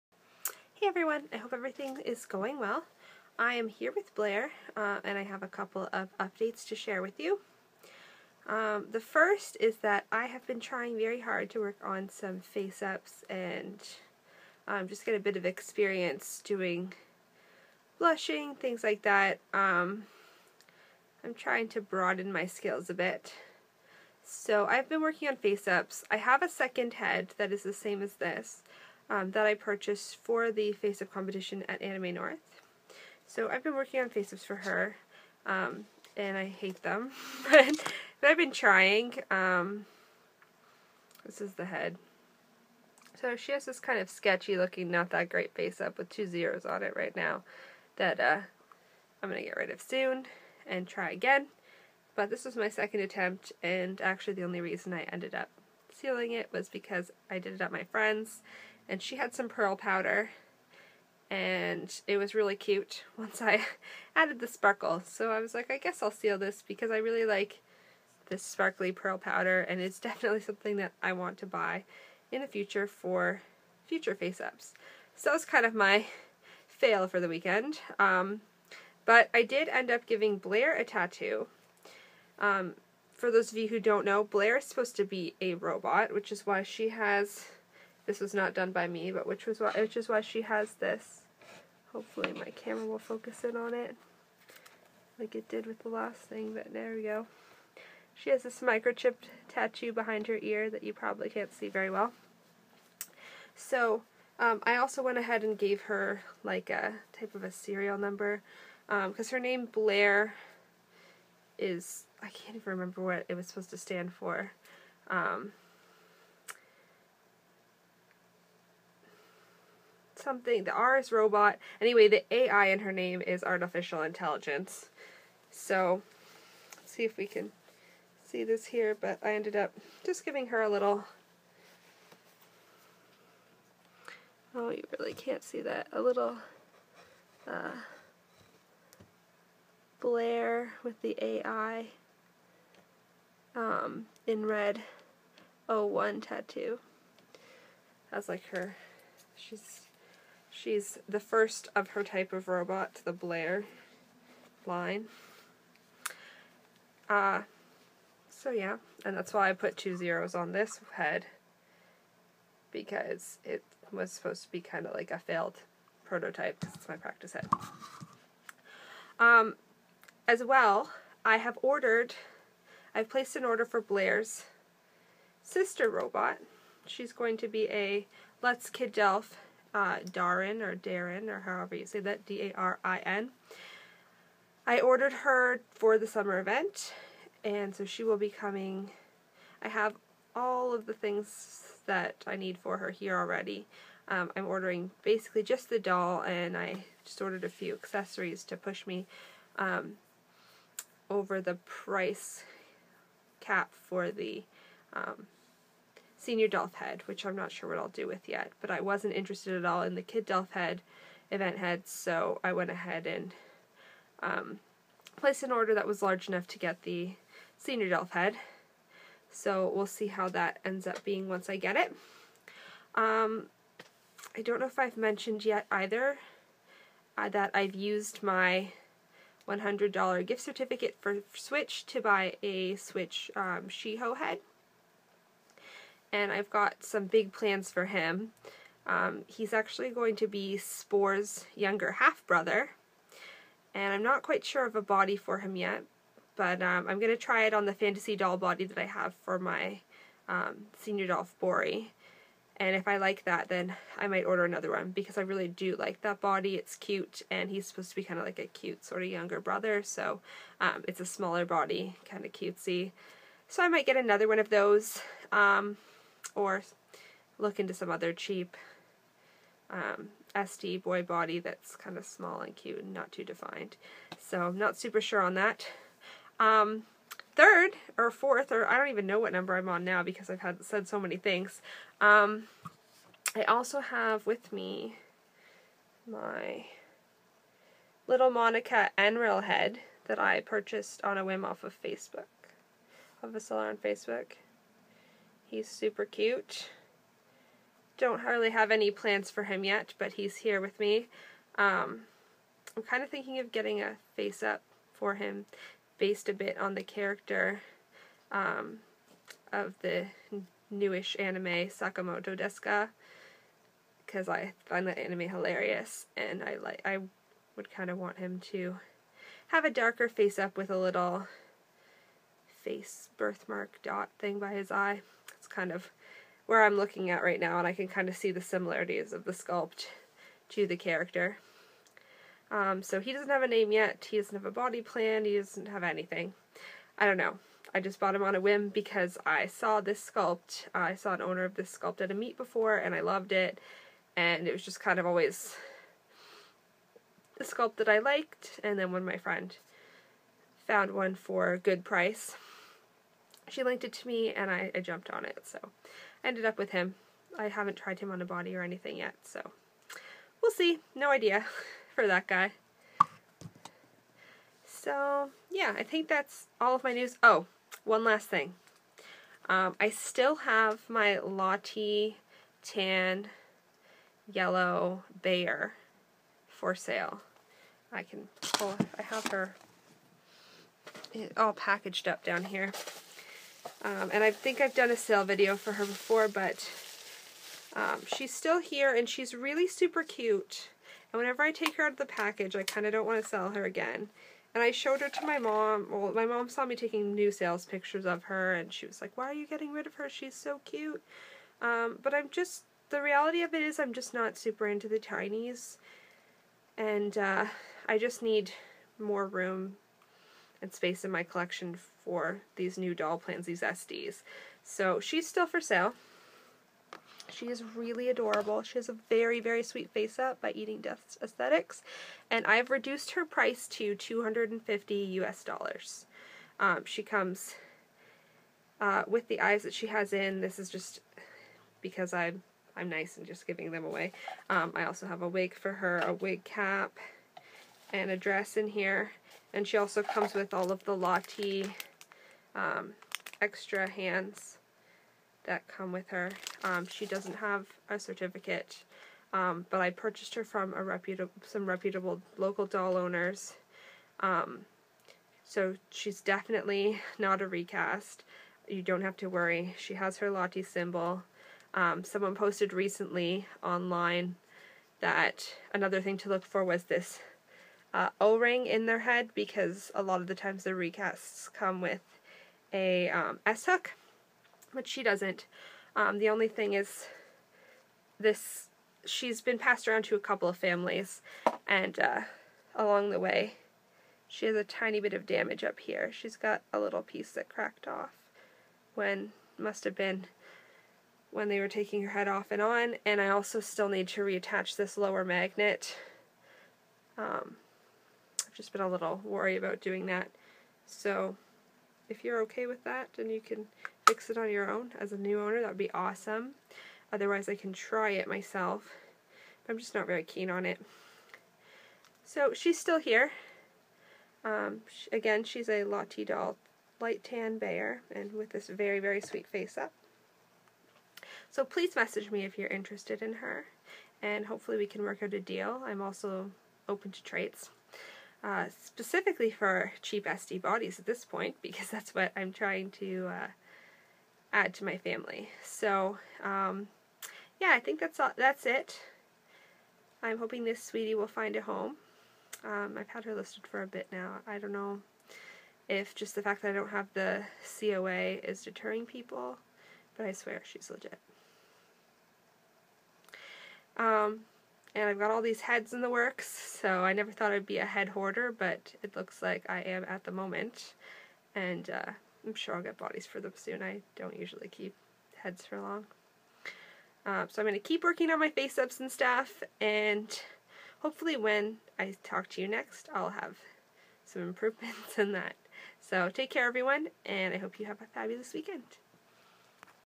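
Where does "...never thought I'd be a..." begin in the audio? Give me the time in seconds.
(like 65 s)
557 s.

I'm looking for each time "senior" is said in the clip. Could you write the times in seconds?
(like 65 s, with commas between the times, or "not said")
206 s, 217 s, 250 s.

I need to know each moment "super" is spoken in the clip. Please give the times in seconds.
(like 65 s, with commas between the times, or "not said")
274 s, 295 s, 389 s, 404 s.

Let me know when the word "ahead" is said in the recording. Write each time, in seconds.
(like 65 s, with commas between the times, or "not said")
105 s, 212 s.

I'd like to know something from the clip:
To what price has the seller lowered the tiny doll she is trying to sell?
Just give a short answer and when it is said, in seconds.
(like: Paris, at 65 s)
250 US dollars, at 423 s.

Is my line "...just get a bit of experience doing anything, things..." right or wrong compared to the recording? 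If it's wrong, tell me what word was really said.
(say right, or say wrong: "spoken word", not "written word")
wrong: "blushing", not "anything".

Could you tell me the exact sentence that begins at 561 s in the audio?
And uh, I'm sure I'll get bodies for them soon.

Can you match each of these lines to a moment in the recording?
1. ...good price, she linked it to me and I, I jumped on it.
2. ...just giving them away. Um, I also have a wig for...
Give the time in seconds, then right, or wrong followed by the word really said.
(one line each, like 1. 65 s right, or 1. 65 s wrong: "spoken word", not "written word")
1. 351 s right
2. 433 s right.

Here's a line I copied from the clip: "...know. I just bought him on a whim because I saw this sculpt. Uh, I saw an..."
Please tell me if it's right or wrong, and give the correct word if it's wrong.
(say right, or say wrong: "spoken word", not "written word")
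right.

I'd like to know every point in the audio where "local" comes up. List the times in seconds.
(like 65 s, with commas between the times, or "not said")
452 s.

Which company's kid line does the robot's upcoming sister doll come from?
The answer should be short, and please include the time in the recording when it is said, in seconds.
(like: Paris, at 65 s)
Luts, at 178 s.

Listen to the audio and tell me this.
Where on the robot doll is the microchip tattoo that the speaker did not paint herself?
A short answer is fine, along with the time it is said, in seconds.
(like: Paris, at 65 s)
behind her ear, at 99 s.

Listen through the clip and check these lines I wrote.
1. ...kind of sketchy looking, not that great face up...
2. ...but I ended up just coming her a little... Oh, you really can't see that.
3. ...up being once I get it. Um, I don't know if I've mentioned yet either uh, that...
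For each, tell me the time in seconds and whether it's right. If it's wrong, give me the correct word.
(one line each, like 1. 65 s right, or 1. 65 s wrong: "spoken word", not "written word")
1. 43 s right
2. 128 s wrong: "giving", not "coming"
3. 220 s right.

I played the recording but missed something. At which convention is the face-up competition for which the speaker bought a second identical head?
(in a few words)
Anime North.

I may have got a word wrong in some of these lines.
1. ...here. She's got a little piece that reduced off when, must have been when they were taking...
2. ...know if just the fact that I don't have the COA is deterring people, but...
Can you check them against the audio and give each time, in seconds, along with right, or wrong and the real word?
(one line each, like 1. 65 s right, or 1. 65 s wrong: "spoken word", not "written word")
1. 485 s wrong: "cracked", not "reduced"
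2. 544 s right.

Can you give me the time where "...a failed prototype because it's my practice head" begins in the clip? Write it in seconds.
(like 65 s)
165 s.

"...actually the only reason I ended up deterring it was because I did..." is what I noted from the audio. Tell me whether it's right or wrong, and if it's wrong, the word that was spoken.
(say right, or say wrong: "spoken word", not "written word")
wrong: "sealing", not "deterring".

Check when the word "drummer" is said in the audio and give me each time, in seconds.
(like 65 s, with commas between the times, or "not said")
not said.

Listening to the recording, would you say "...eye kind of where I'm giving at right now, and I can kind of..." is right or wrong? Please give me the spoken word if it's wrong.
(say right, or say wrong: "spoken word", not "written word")
wrong: "looking", not "giving".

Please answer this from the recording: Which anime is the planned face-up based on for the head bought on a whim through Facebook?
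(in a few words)
Sakamoto desu ga.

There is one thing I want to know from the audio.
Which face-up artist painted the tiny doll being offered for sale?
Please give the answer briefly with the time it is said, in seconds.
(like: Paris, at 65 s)
Eating Death Aesthetics, at 420 s.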